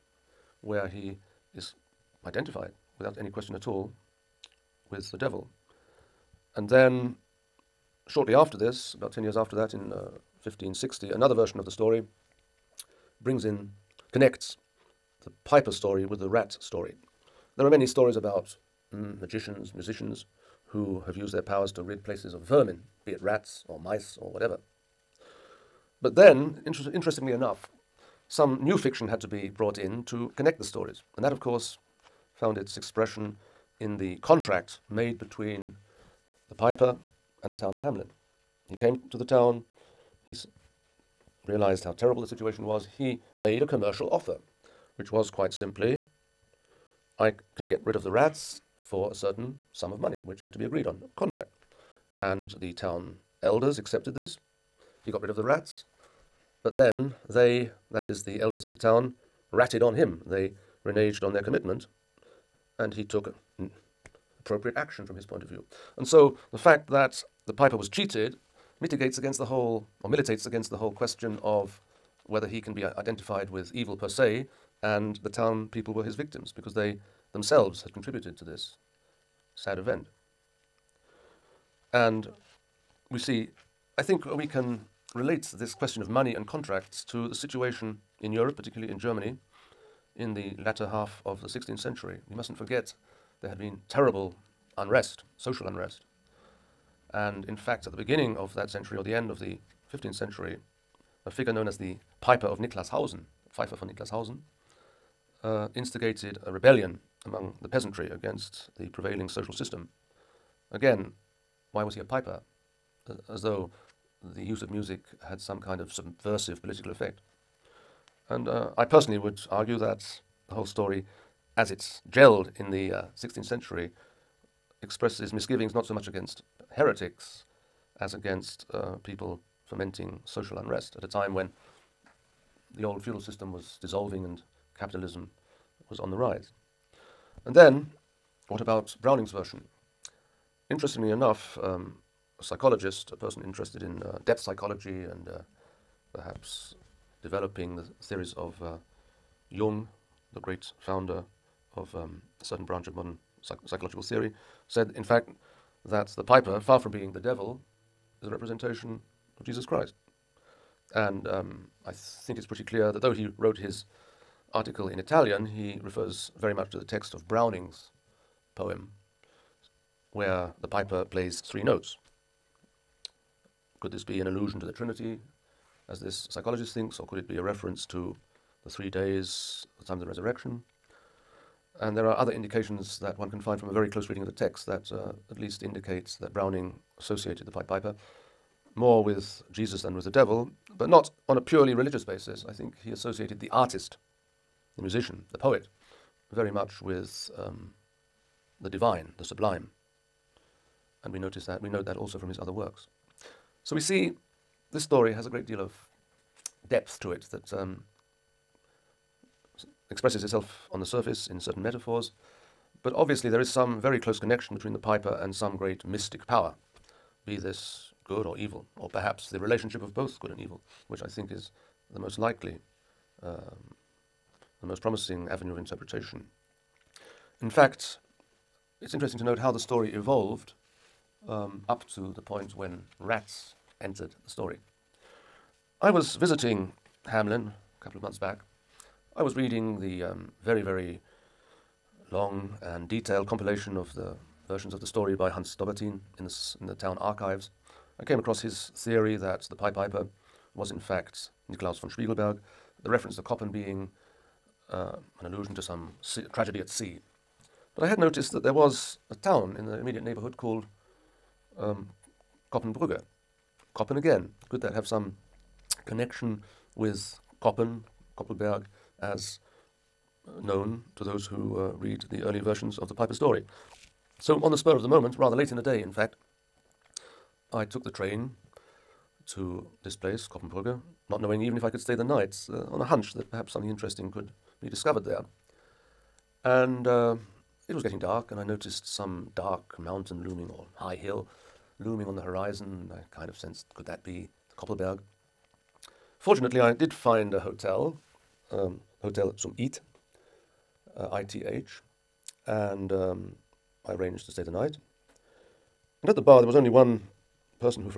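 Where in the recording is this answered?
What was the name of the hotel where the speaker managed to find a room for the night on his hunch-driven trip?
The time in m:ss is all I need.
4:59.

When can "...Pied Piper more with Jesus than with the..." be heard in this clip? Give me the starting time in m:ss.
3:07.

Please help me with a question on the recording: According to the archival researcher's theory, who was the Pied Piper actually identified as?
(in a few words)
Niklaus von Spiegelberg.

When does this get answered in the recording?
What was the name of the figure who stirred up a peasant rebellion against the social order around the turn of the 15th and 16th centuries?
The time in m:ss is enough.
1:42.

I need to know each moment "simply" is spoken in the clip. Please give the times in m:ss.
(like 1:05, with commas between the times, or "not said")
0:45.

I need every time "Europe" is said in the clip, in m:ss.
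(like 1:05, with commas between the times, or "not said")
1:28.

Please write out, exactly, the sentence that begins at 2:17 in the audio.
And then, what about Browning's version?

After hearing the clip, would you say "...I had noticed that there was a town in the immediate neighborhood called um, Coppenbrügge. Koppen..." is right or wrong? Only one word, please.
right.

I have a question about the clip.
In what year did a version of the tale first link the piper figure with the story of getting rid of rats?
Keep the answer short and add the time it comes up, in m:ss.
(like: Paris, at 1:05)
1560, at 0:10.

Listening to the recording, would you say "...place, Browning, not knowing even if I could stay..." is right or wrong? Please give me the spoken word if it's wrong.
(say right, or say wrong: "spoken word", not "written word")
wrong: "Coppenbrügge", not "Browning".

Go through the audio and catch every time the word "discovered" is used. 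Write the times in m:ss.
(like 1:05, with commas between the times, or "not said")
4:44.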